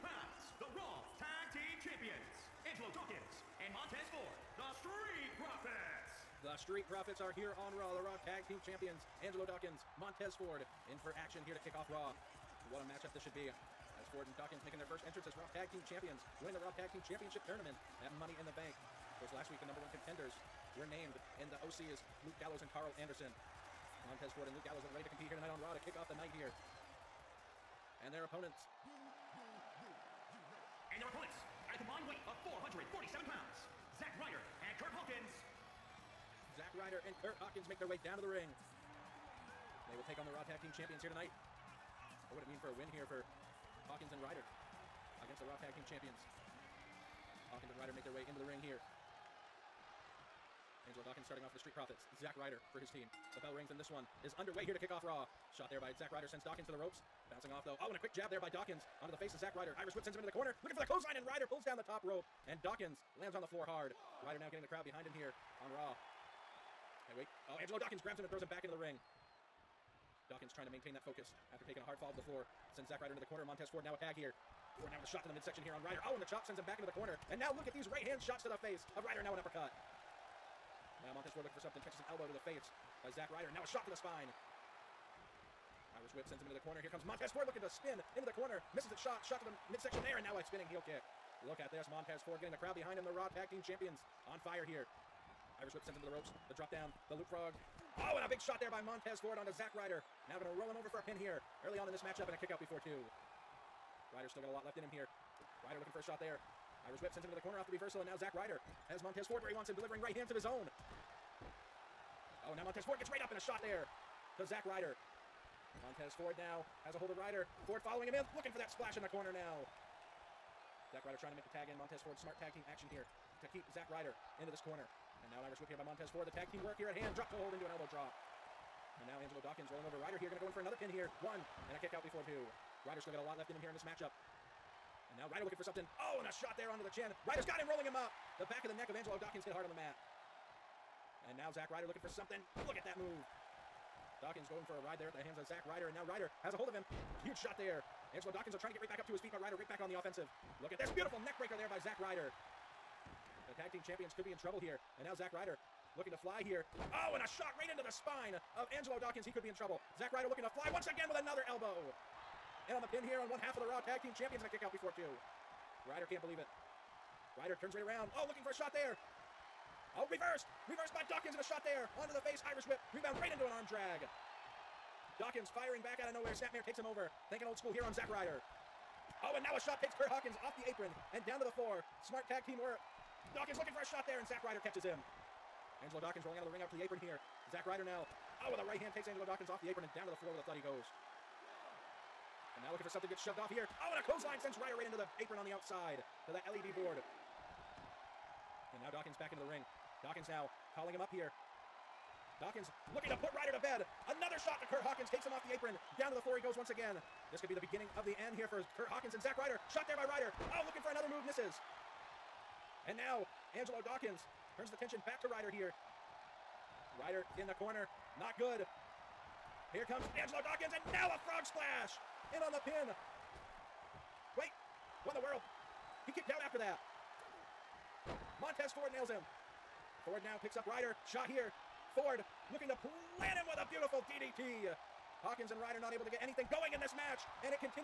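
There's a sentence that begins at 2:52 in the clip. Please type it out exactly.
Rebound right into an arm drag.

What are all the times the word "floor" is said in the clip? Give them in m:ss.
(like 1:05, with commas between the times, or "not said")
1:03, 1:12, 3:01, 3:10, 3:26.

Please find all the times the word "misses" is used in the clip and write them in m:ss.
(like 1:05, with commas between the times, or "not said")
1:28, 3:31.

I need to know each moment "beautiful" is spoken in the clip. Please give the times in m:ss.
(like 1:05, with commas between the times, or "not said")
2:30, 3:53.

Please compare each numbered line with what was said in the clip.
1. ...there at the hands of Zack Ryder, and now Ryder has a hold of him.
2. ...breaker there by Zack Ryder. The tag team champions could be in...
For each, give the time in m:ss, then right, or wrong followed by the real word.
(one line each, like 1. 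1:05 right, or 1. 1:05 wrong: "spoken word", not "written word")
1. 2:24 right
2. 2:31 right.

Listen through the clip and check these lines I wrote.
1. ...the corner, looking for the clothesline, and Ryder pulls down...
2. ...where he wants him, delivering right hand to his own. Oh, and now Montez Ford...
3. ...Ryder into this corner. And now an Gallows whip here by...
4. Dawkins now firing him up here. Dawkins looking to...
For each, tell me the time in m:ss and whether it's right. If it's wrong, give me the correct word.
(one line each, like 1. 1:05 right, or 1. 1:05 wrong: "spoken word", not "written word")
1. 1:00 right
2. 1:49 right
3. 2:03 wrong: "Irish", not "Gallows"
4. 3:20 wrong: "calling", not "firing".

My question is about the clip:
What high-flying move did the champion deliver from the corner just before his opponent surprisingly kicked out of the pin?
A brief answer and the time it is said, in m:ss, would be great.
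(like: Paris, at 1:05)
Frog splash, at 3:41.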